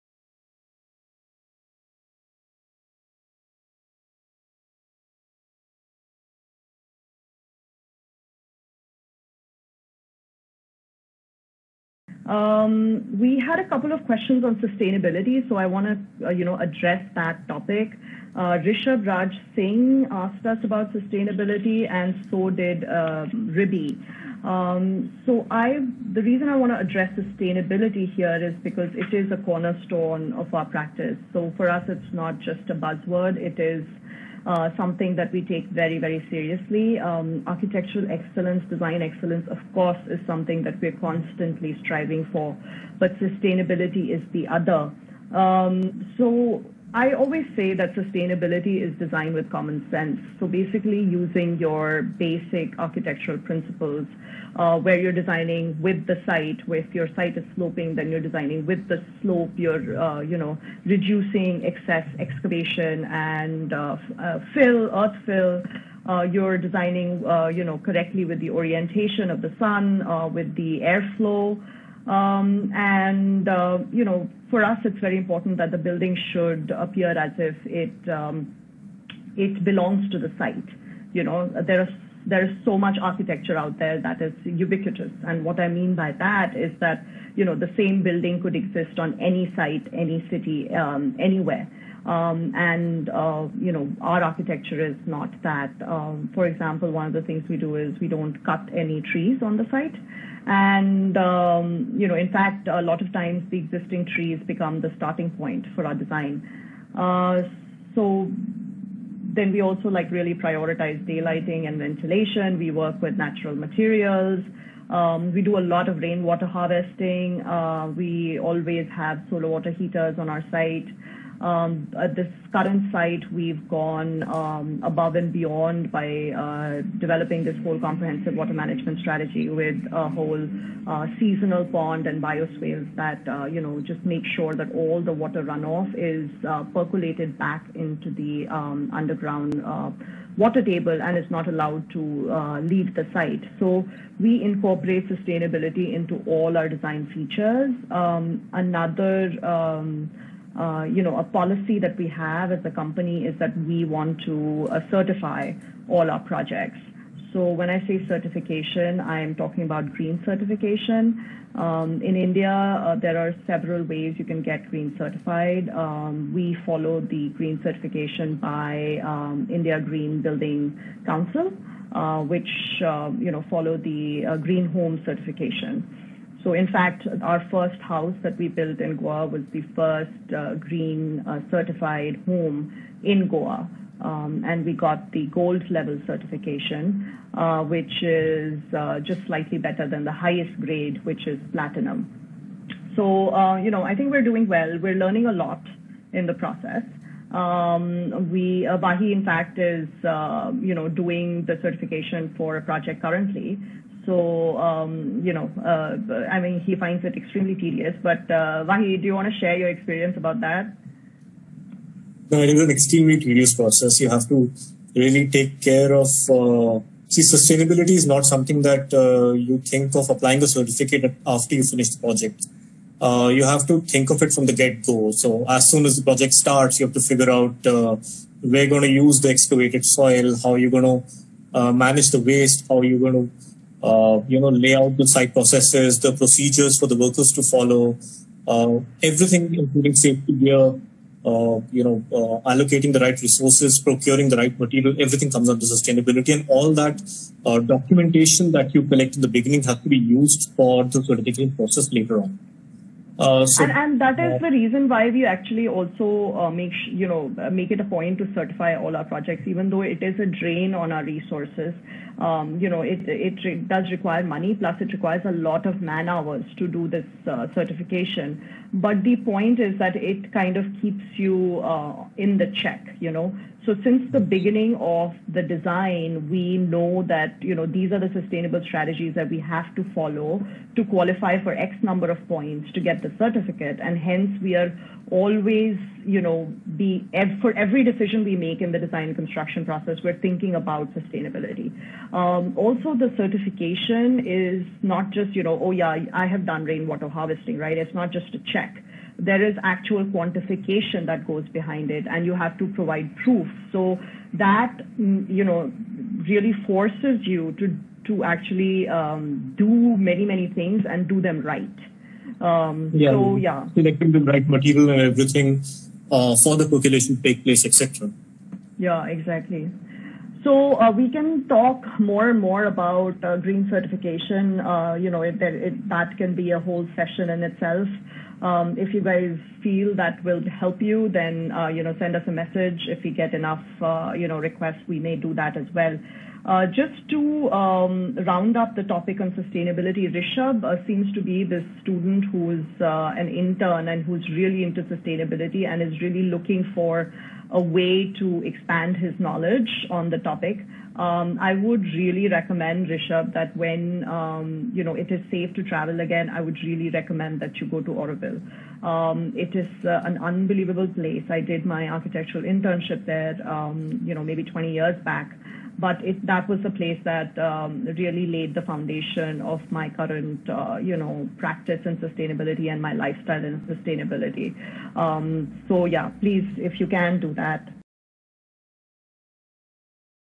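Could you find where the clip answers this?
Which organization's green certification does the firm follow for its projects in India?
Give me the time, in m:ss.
2:49.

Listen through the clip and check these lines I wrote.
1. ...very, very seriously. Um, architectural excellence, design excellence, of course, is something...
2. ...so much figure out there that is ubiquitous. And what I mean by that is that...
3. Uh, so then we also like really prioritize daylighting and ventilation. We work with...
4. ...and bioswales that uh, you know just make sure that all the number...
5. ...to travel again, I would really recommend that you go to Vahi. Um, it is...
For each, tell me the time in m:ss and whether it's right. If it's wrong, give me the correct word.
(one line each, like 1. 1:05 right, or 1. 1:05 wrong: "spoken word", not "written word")
1. 0:35 right
2. 1:22 wrong: "architecture", not "figure"
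3. 1:46 right
4. 2:12 wrong: "water", not "number"
5. 5:55 wrong: "Auroville", not "Vahi".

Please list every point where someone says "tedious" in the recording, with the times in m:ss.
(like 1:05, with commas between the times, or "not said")
3:27, 3:33.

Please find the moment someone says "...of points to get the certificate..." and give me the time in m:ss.
4:42.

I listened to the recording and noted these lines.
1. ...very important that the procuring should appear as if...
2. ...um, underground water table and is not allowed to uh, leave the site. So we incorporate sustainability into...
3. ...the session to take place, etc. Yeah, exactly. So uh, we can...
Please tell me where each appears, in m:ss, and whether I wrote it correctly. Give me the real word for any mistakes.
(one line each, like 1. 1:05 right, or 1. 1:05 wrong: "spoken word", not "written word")
1. 1:14 wrong: "building", not "procuring"
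2. 2:18 right
3. 5:16 wrong: "percolation", not "session".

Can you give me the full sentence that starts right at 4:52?
Um, also, the certification is not just you know oh yeah I have done rainwater harvesting right.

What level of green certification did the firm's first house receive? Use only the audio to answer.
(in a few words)
gold.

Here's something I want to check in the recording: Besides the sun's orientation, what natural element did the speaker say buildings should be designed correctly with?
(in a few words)
airflow.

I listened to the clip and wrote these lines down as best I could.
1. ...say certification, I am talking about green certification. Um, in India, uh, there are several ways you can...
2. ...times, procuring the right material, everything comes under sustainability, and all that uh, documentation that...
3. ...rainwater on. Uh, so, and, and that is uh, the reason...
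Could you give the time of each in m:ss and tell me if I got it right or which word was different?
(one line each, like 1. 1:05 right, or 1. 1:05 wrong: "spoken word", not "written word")
1. 2:37 right
2. 4:03 wrong: "resources", not "times"
3. 4:11 wrong: "later", not "rainwater".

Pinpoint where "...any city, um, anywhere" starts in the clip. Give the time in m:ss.
1:29.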